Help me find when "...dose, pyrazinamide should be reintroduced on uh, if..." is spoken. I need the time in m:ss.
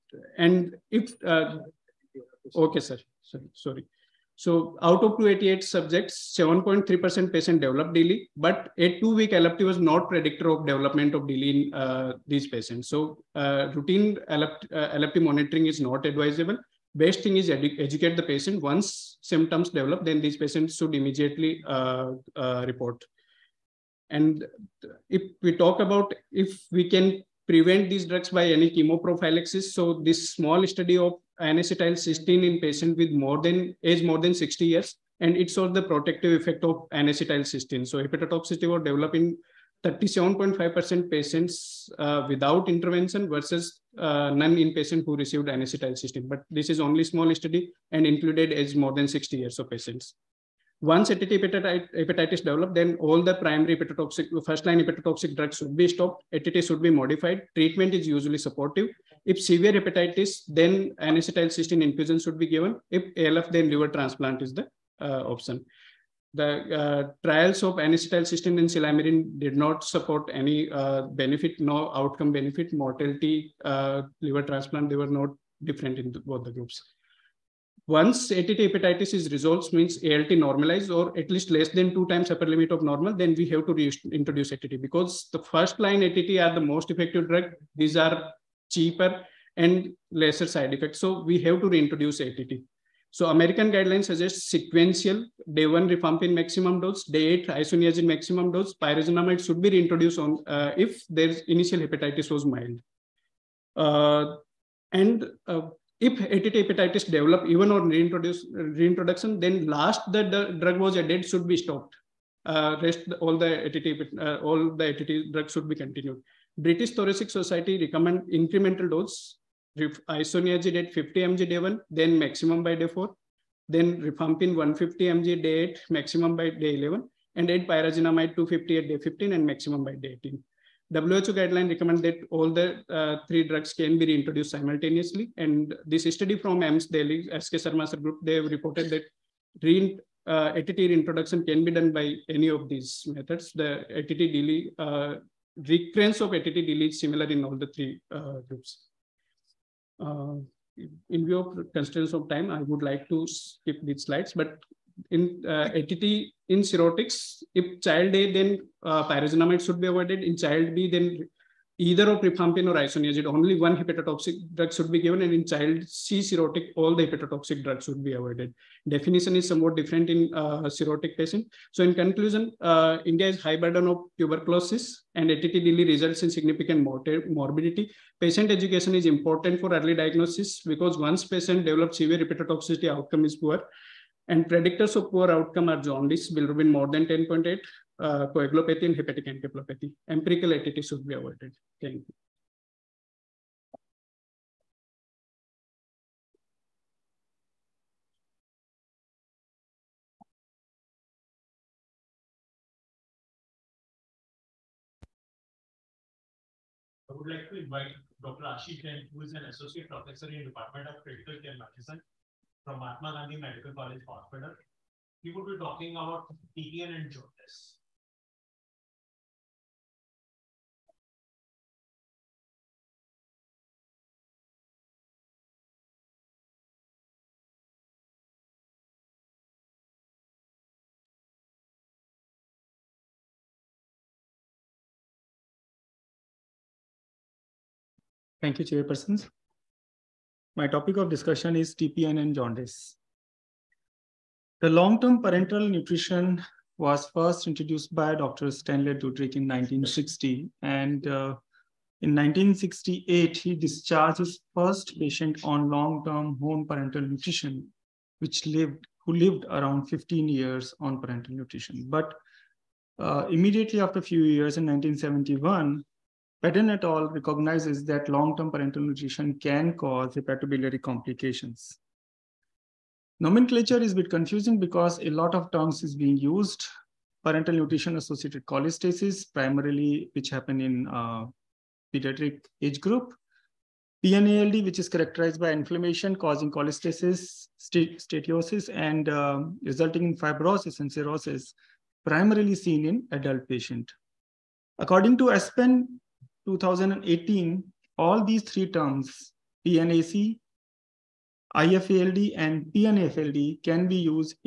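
1:38.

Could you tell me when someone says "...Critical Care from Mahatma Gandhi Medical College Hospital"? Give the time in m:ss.
3:31.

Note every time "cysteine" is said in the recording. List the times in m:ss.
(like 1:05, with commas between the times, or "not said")
0:31, 0:36, 0:45, 1:00, 1:07.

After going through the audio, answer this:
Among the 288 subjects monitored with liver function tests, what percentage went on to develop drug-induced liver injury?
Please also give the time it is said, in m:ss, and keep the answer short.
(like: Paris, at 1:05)
7.3%, at 0:06.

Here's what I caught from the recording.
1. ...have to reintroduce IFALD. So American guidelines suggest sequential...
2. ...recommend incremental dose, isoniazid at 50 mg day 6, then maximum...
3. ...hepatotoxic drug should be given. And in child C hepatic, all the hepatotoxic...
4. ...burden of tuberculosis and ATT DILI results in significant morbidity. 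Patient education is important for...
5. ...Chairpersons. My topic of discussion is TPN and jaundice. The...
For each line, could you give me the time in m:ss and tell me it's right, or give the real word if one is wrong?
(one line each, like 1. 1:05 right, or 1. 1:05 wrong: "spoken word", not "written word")
1. 1:31 wrong: "ATT", not "IFALD"
2. 1:57 wrong: "1", not "6"
3. 2:43 wrong: "cirrhotic", not "hepatic"
4. 2:53 right
5. 3:58 right.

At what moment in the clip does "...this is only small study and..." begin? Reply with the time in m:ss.
0:46.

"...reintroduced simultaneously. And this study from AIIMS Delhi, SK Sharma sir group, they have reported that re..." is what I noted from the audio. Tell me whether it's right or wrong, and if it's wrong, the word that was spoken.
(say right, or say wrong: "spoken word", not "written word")
right.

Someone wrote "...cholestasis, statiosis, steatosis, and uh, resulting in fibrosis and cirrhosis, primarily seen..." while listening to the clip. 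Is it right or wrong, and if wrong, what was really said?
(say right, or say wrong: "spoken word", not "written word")
right.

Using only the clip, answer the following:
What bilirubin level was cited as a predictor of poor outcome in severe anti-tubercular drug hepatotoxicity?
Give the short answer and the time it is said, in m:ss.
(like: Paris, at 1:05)
10.8, at 3:07.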